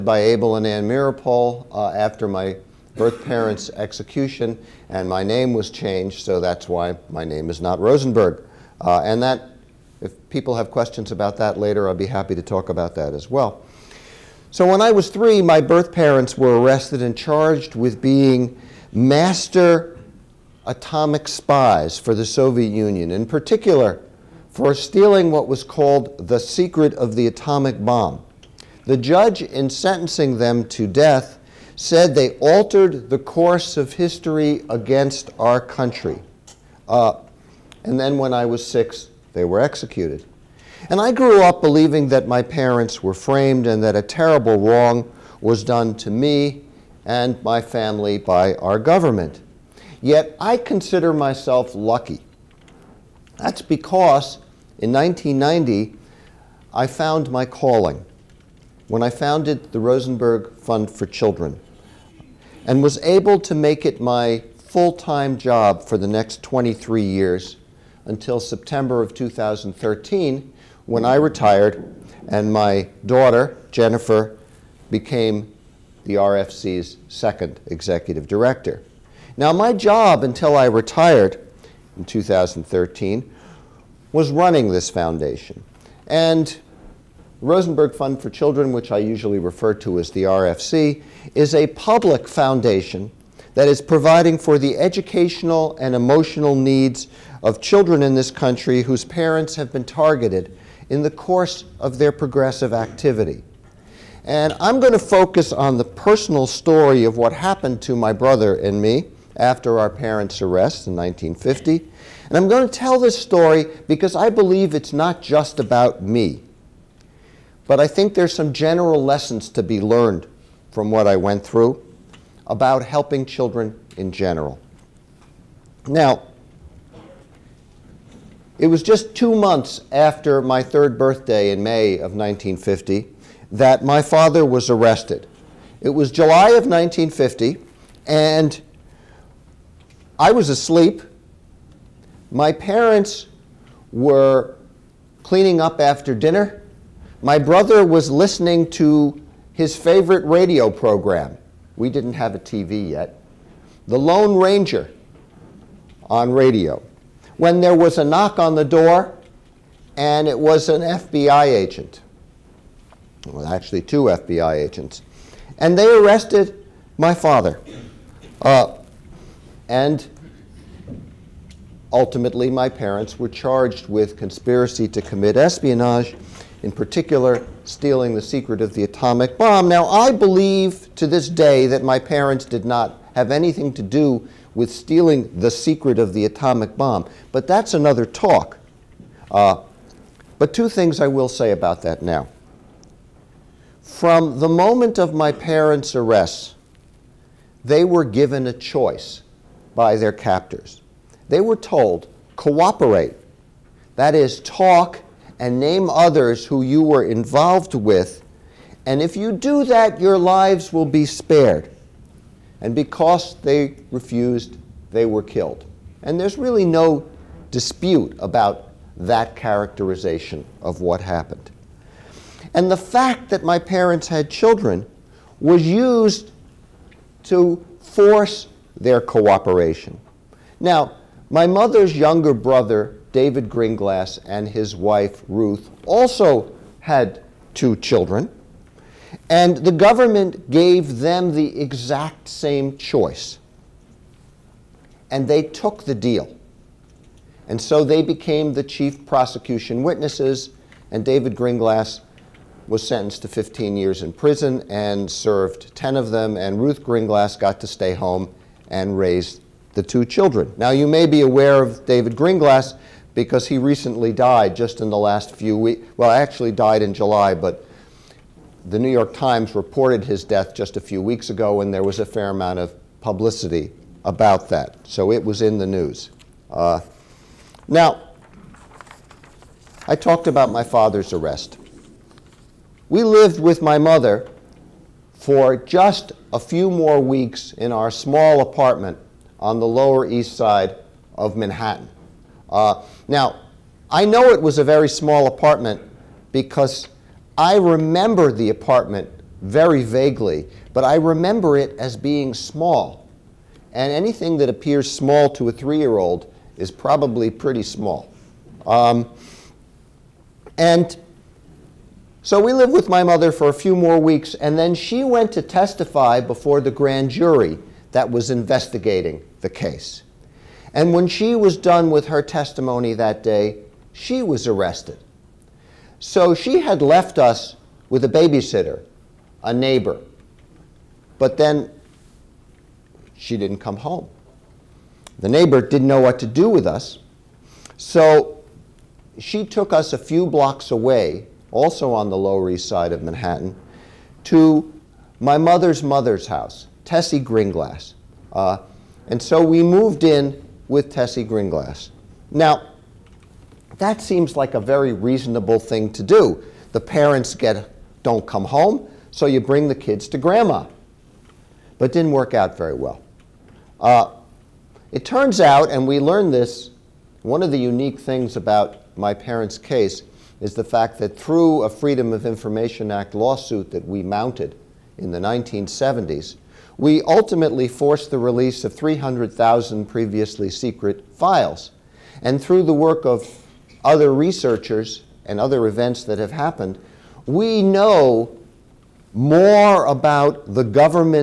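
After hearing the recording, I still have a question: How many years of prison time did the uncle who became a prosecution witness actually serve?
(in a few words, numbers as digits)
10.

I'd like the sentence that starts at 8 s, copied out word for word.
Uh, and that, if people have questions about that later, i would be happy to talk about that as well.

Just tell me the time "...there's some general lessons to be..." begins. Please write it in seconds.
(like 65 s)
118 s.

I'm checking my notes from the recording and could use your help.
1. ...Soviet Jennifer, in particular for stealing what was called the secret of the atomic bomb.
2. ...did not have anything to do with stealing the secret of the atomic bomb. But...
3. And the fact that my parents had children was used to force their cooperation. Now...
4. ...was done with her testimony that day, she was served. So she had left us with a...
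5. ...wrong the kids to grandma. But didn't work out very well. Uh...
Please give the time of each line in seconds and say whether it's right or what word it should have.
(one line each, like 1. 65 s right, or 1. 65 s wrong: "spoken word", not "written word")
1. 22 s wrong: "Union", not "Jennifer"
2. 182 s right
3. 222 s right
4. 321 s wrong: "arrested", not "served"
5. 359 s wrong: "bring", not "wrong".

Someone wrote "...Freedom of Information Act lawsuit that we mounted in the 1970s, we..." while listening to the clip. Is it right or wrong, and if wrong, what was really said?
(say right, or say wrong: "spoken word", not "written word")
right.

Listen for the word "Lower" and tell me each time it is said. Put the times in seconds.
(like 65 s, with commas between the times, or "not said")
289 s, 342 s.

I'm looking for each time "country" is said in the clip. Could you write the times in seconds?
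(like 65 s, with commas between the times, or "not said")
35 s, 98 s.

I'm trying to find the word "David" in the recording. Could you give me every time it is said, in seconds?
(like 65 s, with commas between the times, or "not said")
233 s, 251 s, 261 s.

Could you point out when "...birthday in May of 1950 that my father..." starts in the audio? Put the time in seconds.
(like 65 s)
130 s.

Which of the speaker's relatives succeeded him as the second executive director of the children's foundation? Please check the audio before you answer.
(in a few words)
Jennifer.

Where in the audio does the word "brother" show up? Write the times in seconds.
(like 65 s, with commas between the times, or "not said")
108 s, 147 s, 232 s.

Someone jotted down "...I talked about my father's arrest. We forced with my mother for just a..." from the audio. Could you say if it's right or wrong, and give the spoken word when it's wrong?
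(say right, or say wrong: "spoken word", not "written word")
wrong: "lived", not "forced".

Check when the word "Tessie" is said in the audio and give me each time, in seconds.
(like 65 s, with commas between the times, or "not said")
346 s, 350 s.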